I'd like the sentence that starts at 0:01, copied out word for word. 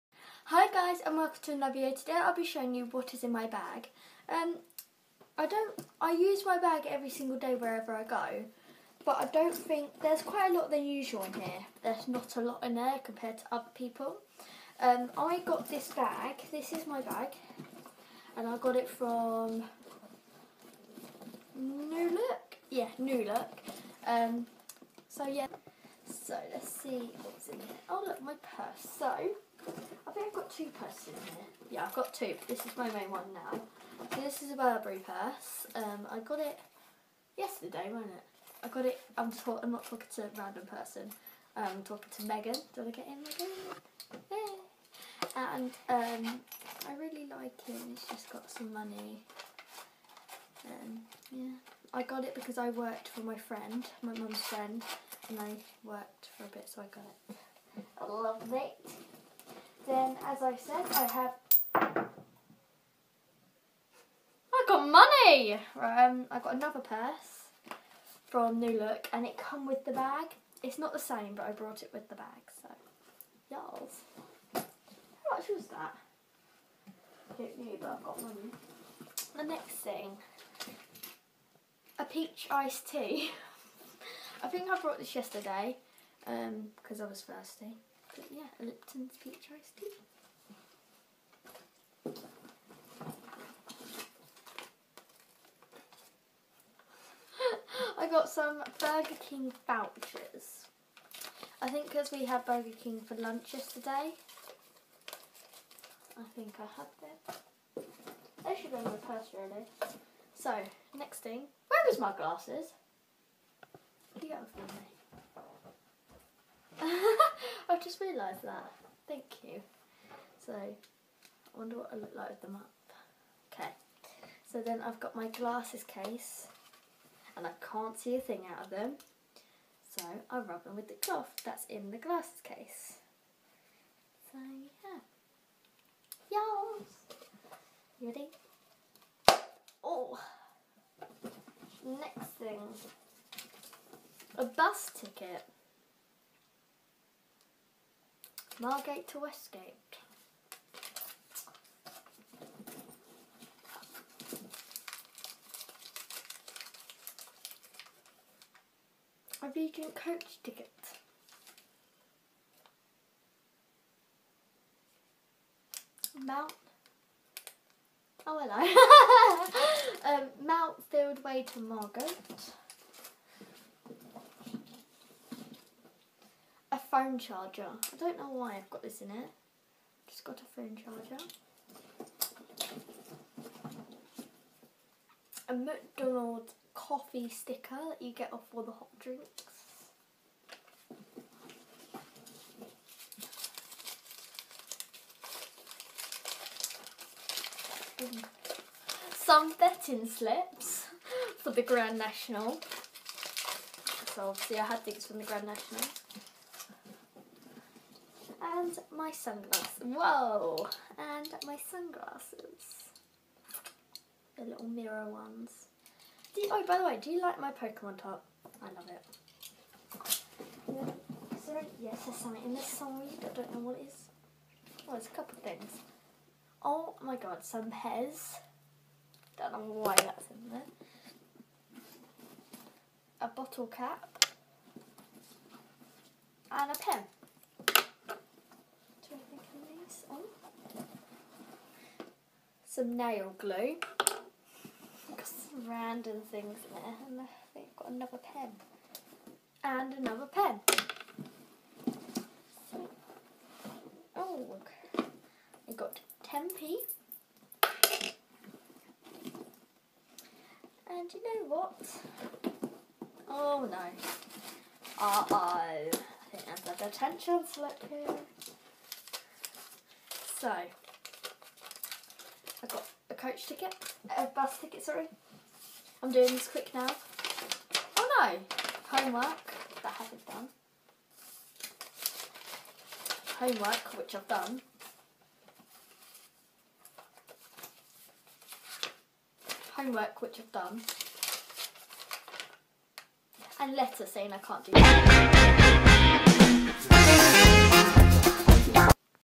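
Today I'll be showing you what is in my bag.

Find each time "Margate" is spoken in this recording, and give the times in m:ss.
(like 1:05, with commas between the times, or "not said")
2:28, 2:51.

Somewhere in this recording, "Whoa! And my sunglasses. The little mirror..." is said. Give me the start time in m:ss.
3:29.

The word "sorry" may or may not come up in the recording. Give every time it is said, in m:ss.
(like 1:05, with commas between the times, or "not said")
3:41, 4:34.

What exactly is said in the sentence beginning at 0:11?
There's not a lot in there compared to other people.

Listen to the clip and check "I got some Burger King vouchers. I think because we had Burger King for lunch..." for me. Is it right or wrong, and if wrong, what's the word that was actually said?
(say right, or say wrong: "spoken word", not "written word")
right.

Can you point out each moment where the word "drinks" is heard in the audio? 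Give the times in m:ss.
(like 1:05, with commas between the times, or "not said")
3:08.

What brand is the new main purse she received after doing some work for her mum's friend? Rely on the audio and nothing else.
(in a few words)
Burberry.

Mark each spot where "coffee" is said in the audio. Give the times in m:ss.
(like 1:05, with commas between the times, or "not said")
3:06.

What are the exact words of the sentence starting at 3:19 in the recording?
Some betting slips for the Grand National.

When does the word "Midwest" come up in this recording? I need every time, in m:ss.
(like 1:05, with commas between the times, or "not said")
not said.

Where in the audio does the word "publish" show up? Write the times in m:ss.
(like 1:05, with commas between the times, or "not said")
not said.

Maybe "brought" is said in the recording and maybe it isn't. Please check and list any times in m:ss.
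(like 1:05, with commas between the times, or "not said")
1:11, 1:24.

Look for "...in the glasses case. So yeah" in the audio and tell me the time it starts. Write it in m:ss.
2:11.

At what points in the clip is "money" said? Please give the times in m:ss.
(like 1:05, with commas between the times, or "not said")
0:48, 1:04, 1:18.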